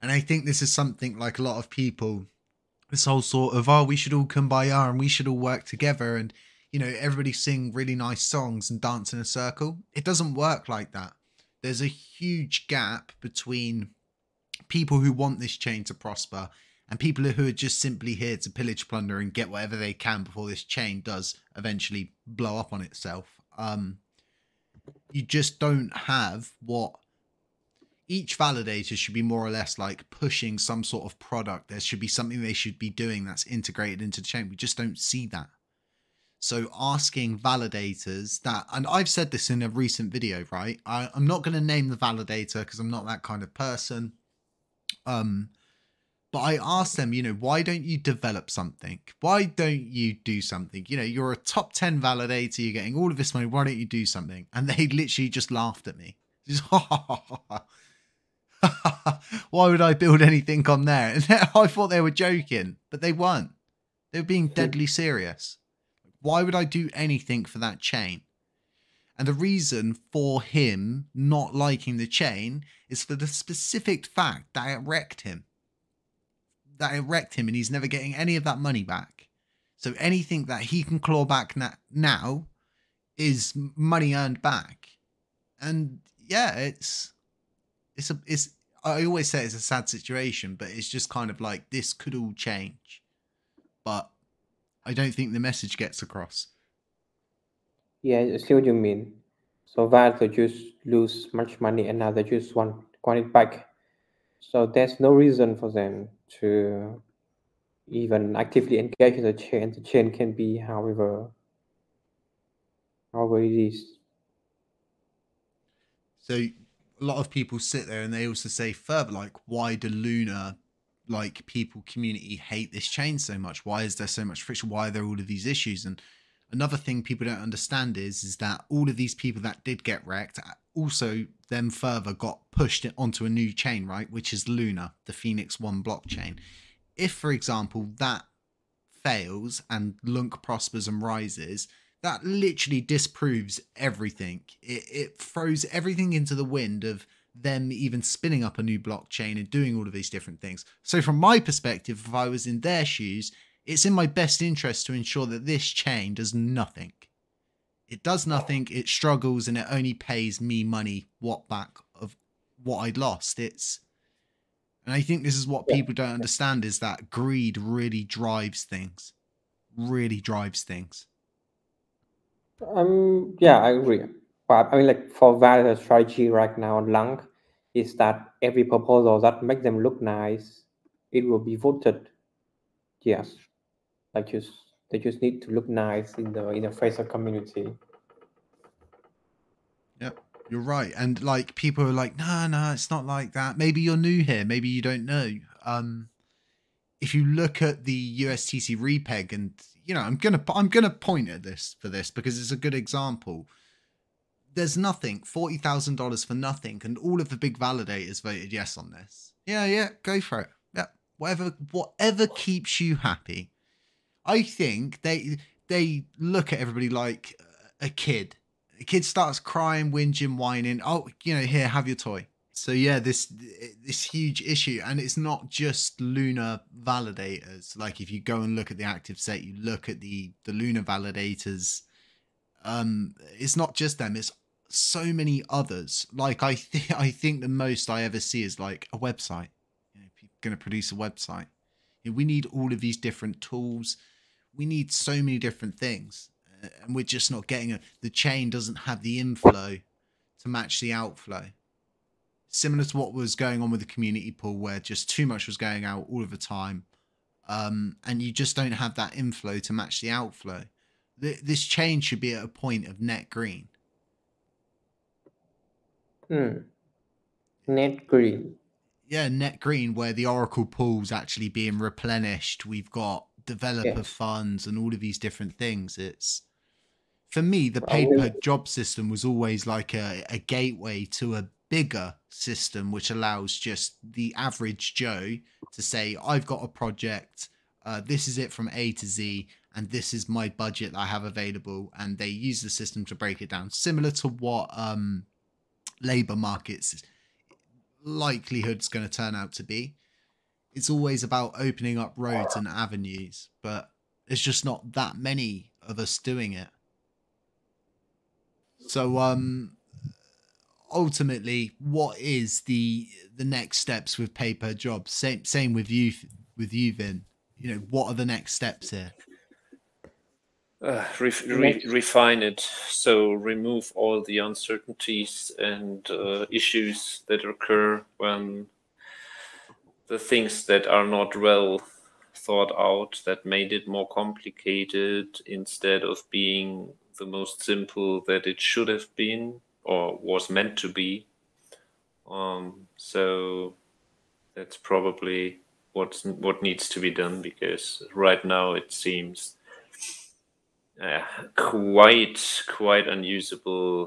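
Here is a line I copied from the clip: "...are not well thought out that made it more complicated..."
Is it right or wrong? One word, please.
right.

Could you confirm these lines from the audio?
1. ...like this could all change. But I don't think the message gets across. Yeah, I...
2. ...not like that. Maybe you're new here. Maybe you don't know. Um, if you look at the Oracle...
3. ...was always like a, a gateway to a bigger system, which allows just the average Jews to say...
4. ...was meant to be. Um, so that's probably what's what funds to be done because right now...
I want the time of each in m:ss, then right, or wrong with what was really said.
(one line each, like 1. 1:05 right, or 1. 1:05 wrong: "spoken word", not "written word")
1. 1:31 right
2. 3:12 wrong: "USTC", not "Oracle"
3. 4:39 wrong: "Joe", not "Jews"
4. 5:40 wrong: "needs", not "funds".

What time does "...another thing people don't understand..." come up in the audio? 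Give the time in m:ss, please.
2:06.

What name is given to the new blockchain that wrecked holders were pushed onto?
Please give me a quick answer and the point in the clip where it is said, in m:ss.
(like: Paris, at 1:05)
Phoenix One, at 2:15.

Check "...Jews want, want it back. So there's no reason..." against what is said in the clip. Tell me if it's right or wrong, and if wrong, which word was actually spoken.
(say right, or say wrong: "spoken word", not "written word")
right.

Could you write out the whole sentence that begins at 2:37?
It does nothing, it struggles, and it only pays me money what back of what I'd lost.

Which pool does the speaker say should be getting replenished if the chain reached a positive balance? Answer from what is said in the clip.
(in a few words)
Oracle pool.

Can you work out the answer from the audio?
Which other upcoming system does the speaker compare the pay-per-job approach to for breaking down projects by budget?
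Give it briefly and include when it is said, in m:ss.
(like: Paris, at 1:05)
labor markets, at 4:56.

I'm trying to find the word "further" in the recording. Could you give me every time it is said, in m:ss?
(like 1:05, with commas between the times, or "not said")
1:58, 2:11.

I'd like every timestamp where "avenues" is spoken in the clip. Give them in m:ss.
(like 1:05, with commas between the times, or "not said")
5:02.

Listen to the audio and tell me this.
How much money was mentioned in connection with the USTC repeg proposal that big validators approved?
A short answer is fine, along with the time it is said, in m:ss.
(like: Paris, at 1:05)
$40,000, at 3:25.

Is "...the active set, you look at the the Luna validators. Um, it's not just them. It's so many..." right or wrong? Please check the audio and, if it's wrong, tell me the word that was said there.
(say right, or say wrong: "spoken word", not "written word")
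right.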